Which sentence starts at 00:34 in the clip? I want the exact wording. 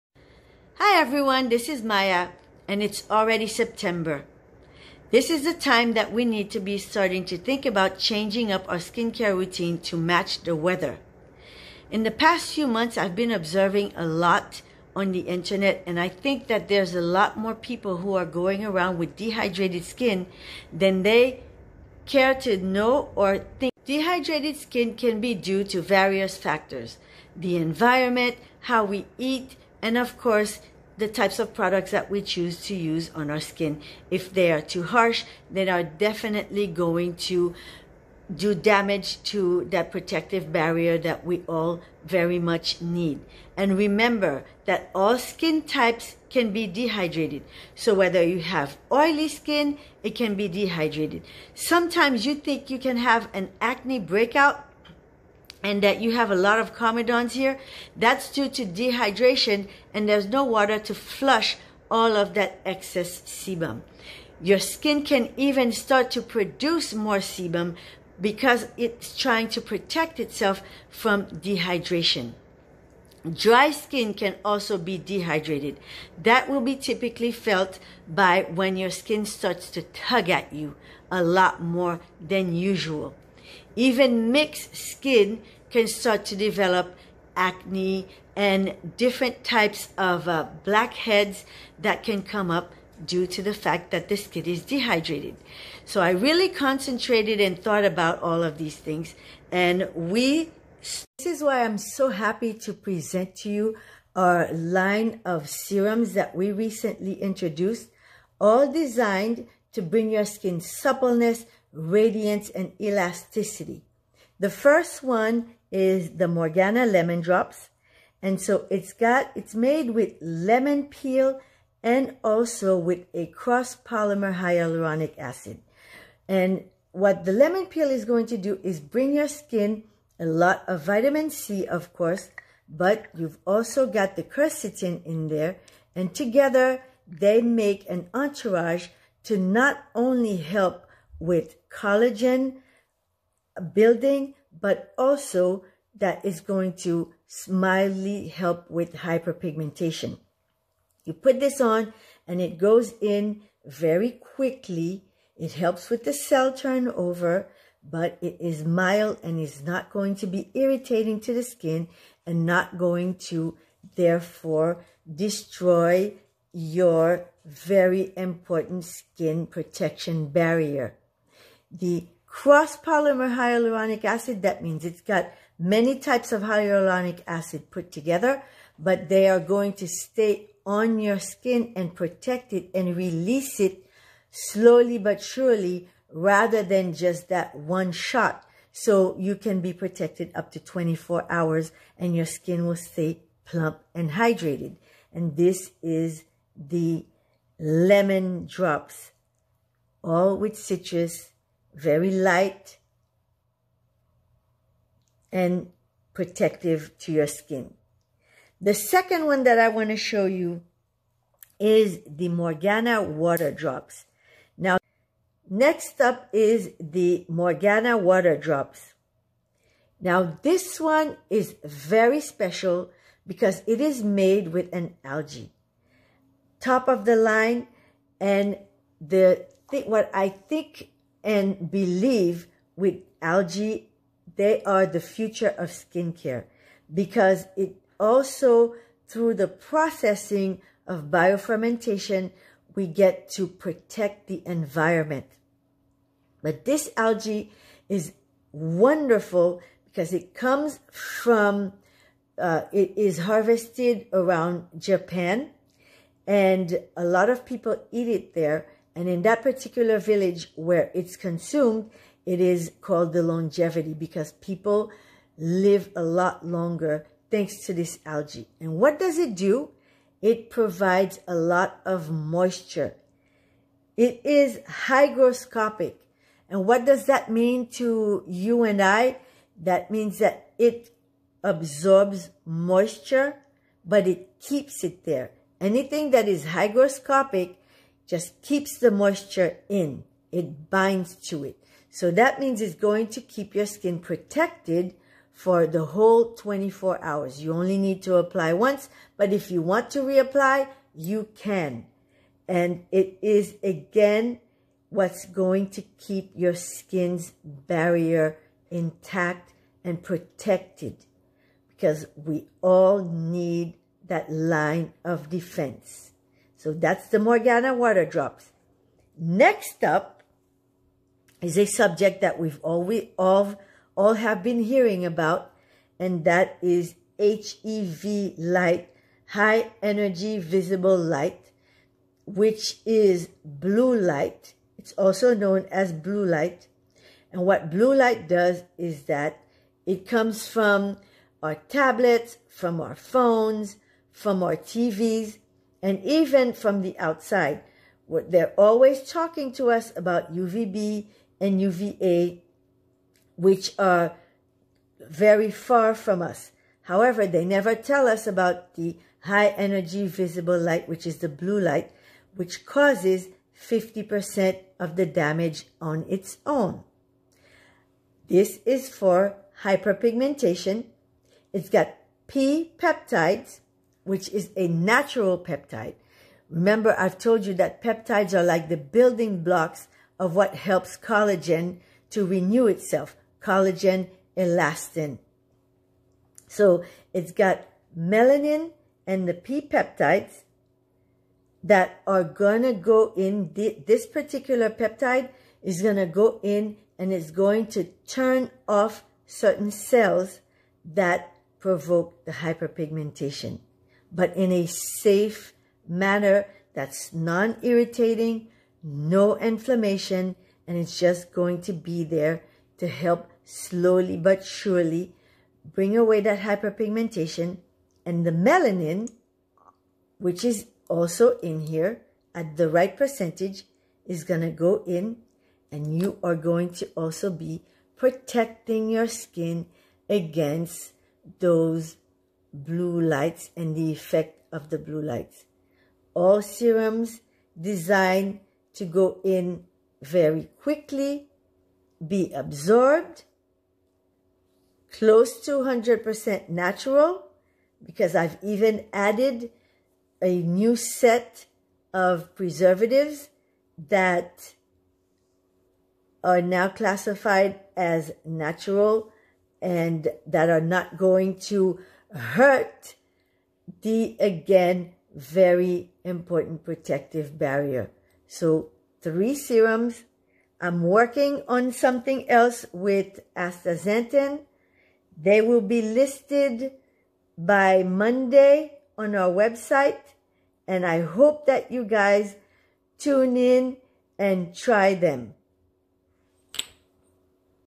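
If they are too harsh, they are definitely going to do damage to that protective barrier that we all very much need.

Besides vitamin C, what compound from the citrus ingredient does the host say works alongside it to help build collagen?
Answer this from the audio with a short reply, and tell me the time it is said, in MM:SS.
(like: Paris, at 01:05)
Quercetin, at 02:14.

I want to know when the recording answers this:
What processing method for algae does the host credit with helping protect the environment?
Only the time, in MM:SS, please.
04:01.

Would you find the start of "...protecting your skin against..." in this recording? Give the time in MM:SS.
07:07.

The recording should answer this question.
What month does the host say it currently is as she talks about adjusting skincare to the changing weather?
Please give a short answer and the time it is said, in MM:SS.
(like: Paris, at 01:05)
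September, at 00:03.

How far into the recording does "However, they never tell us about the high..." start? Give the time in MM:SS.
05:56.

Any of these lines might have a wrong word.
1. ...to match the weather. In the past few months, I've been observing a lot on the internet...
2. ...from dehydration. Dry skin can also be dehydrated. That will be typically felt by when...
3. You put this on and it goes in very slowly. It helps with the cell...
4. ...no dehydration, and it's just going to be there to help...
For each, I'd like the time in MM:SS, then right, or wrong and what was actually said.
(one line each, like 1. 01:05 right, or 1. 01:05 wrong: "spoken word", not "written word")
1. 00:09 right
2. 01:10 right
3. 02:31 wrong: "quickly", not "slowly"
4. 06:48 wrong: "inflammation", not "dehydration".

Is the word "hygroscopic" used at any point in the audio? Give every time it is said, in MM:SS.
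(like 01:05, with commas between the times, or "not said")
04:34, 04:46.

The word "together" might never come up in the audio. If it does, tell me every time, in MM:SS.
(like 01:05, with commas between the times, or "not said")
02:16, 02:57.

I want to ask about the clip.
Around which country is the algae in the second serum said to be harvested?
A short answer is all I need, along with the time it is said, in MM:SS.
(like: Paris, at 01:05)
Japan, at 04:14.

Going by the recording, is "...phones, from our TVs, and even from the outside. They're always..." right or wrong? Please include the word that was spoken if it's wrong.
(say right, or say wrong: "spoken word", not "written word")
right.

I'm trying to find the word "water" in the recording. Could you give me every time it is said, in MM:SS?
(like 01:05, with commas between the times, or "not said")
01:00, 03:33, 03:37, 05:17.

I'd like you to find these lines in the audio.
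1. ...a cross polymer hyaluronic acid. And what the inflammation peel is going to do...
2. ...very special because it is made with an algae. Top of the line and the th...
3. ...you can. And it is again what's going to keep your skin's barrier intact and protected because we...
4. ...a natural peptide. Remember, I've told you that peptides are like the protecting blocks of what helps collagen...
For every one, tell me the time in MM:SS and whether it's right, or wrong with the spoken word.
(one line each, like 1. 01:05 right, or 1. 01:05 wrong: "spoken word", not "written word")
1. 02:03 wrong: "lemon", not "inflammation"
2. 03:41 right
3. 05:00 right
4. 06:14 wrong: "building", not "protecting".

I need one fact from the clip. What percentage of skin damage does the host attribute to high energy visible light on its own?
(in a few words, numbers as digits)
50%.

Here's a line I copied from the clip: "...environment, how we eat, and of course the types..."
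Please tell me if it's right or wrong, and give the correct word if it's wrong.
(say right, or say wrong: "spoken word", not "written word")
right.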